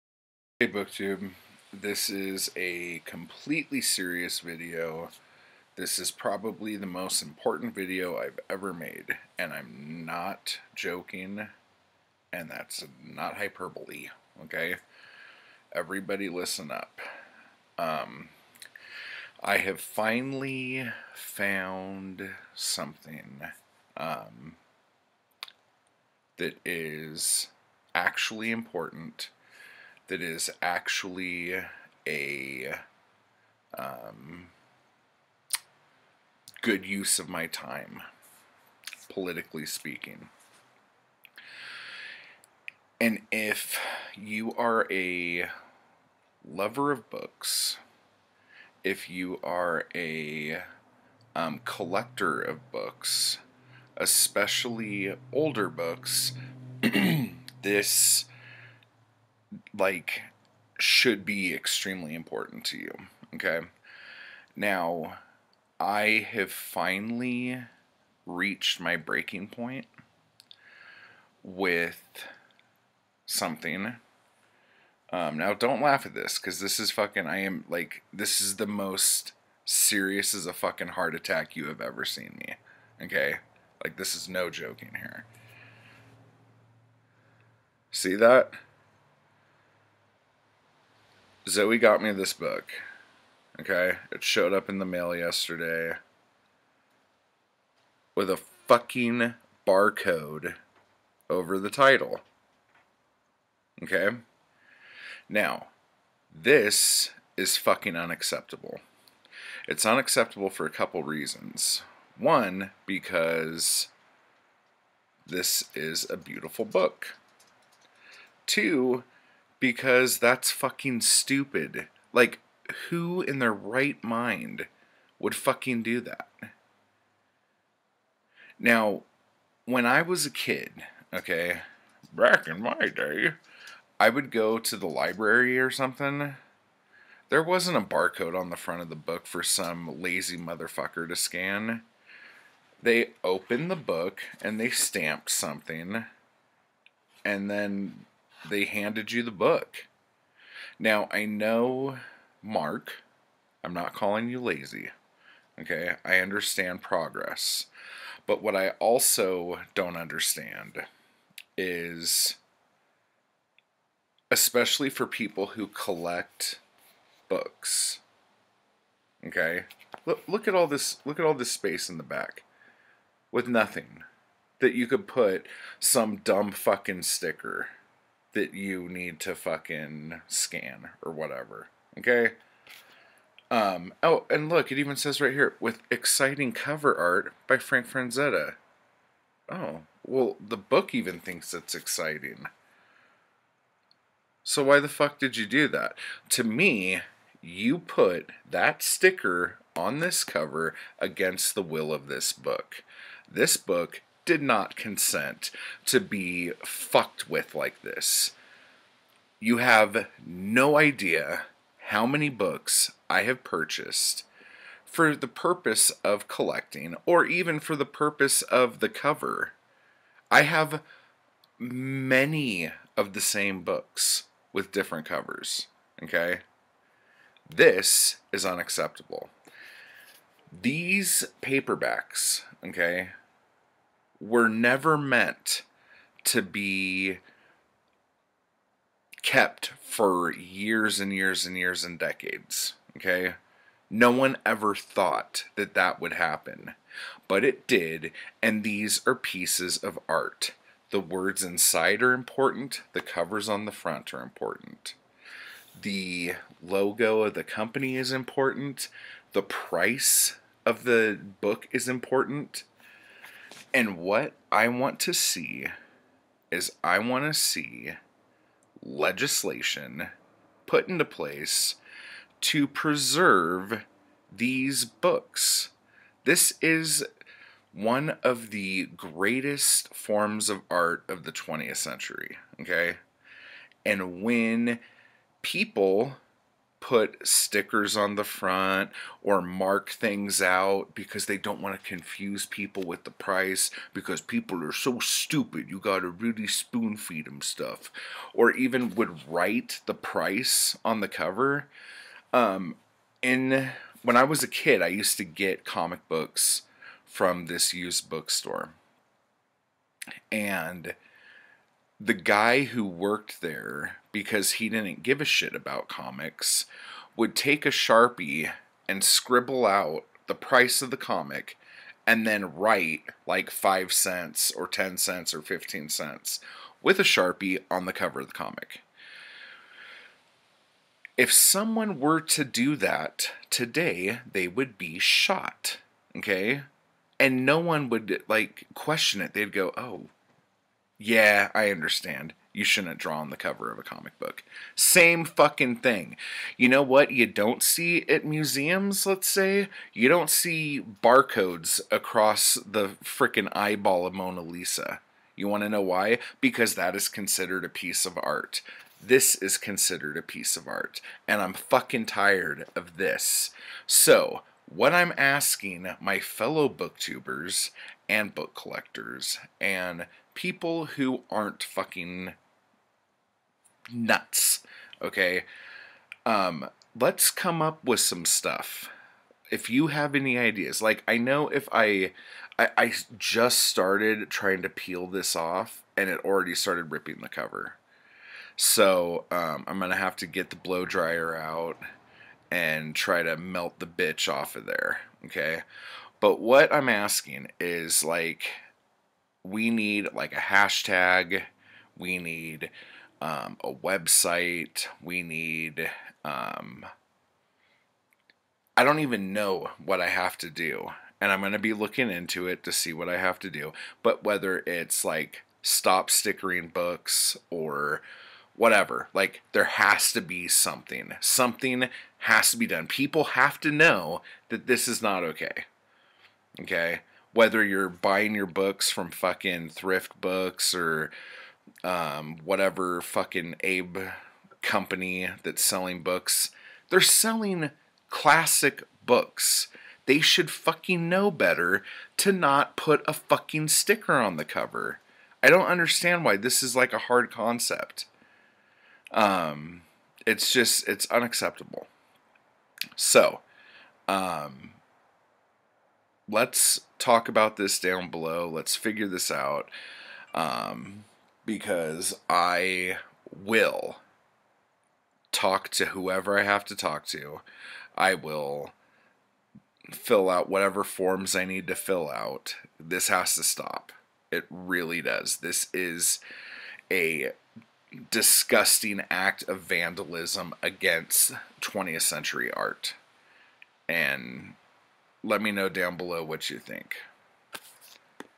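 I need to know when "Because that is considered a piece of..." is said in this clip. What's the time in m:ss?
5:56.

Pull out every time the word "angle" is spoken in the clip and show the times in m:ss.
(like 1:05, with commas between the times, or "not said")
not said.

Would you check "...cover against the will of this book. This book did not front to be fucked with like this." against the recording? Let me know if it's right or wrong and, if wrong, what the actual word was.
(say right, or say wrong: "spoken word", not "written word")
wrong: "consent", not "front".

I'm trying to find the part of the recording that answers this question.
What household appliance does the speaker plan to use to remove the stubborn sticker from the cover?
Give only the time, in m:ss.
6:30.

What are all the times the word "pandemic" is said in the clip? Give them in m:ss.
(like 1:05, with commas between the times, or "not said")
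not said.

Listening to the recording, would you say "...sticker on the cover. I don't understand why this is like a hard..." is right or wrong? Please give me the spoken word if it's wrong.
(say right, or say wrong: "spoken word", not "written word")
right.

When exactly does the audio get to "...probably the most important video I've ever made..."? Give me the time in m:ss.
0:06.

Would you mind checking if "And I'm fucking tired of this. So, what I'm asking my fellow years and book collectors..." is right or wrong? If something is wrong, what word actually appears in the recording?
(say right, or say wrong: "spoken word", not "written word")
wrong: "booktubers", not "years".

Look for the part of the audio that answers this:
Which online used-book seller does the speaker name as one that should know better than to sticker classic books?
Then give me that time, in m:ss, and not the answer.
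7:09.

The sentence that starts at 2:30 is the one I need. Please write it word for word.
Now, I know, Mark, I'm not calling you lazy.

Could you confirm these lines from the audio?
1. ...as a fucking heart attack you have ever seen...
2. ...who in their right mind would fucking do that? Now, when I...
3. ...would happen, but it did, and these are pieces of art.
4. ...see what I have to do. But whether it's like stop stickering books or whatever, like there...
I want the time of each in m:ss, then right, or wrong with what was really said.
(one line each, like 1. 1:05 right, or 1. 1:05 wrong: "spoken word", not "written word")
1. 1:20 right
2. 2:02 right
3. 4:05 right
4. 6:52 right.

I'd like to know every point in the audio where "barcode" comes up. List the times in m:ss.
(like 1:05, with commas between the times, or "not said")
1:39, 2:17, 5:51.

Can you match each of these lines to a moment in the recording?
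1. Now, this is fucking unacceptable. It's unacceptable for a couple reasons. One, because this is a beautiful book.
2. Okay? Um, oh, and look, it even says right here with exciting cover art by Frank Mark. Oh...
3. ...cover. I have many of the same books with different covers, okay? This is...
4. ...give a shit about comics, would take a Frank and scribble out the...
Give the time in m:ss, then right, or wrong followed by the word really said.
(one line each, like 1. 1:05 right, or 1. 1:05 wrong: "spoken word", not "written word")
1. 1:45 right
2. 3:01 wrong: "Frazetta", not "Mark"
3. 3:38 right
4. 5:15 wrong: "Sharpie", not "Frank".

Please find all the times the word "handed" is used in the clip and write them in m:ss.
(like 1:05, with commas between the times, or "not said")
2:28.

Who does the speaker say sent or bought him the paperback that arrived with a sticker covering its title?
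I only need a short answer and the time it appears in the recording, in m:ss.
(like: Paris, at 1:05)
Zoe, at 1:31.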